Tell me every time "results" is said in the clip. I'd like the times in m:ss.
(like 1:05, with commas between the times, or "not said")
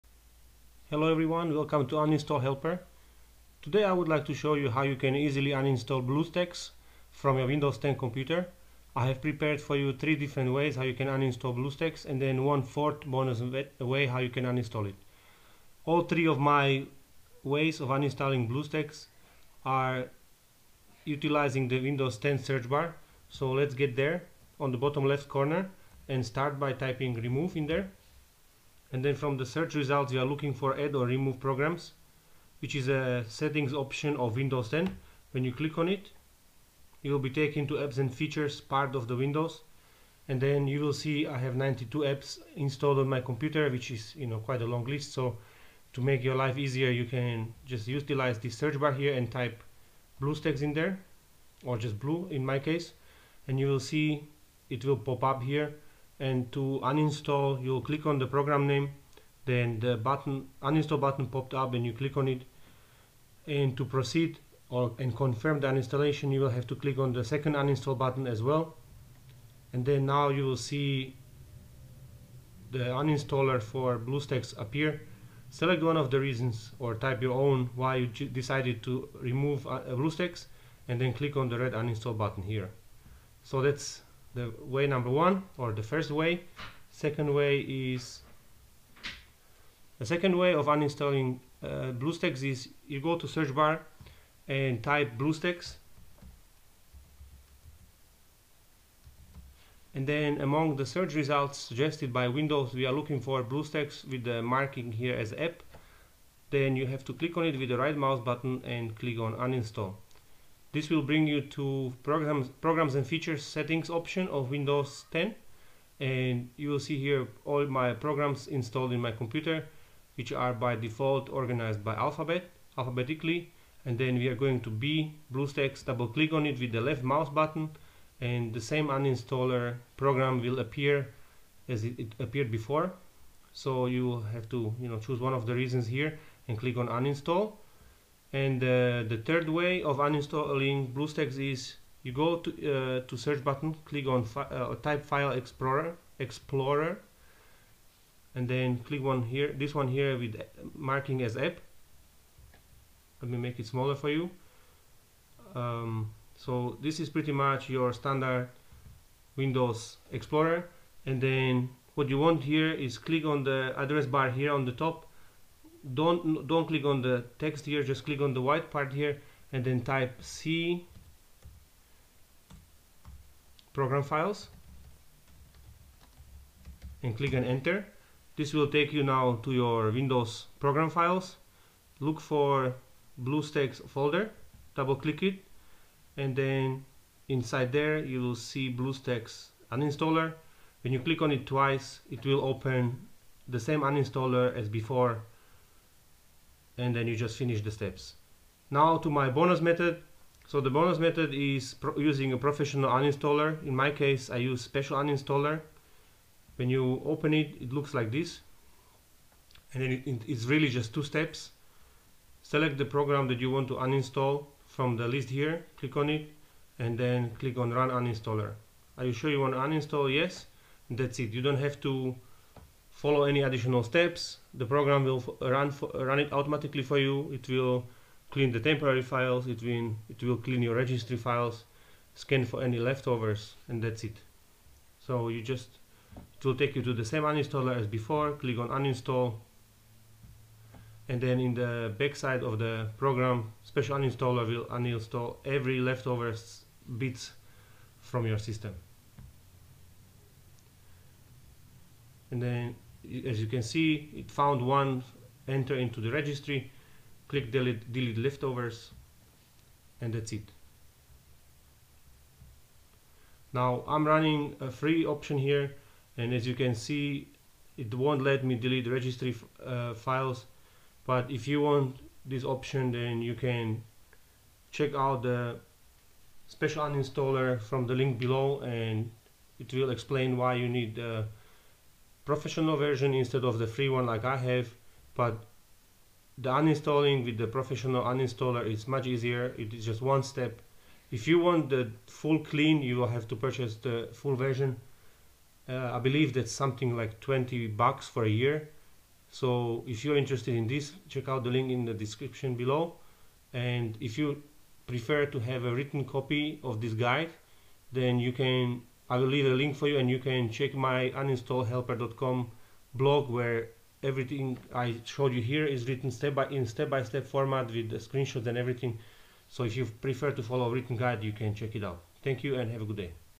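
0:29, 1:41.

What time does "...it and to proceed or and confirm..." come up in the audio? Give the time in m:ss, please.
1:02.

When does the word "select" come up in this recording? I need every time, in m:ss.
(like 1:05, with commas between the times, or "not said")
1:15, 3:32.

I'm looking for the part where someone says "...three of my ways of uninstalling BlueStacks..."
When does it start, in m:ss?
0:16.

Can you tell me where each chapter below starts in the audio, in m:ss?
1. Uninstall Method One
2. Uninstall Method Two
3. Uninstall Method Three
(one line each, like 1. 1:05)
1. 0:15
2. 1:26
3. 2:18.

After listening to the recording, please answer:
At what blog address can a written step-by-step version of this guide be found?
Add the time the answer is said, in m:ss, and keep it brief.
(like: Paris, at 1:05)
uninstallhelper.com, at 5:11.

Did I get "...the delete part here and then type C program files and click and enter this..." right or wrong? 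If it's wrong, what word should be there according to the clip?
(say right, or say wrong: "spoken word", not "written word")
wrong: "white", not "delete".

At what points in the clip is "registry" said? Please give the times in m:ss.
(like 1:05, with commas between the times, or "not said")
3:50, 4:16, 4:28.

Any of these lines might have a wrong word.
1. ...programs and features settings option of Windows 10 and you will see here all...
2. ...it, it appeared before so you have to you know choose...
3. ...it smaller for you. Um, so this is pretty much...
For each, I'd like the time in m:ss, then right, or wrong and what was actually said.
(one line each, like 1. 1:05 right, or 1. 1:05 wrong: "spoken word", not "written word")
1. 1:52 right
2. 2:11 right
3. 2:33 right.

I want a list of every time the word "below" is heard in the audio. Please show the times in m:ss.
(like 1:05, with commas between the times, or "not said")
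4:38, 5:02.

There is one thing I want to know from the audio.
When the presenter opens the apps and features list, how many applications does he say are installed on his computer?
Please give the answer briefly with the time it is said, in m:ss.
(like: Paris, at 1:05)
92, at 0:41.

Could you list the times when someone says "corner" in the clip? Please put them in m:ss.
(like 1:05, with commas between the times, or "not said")
0:25.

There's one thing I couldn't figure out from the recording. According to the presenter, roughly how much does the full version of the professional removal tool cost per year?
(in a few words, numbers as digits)
20 bucks.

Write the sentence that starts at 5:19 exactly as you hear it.
So if you prefer to follow a written guide, you can check it out.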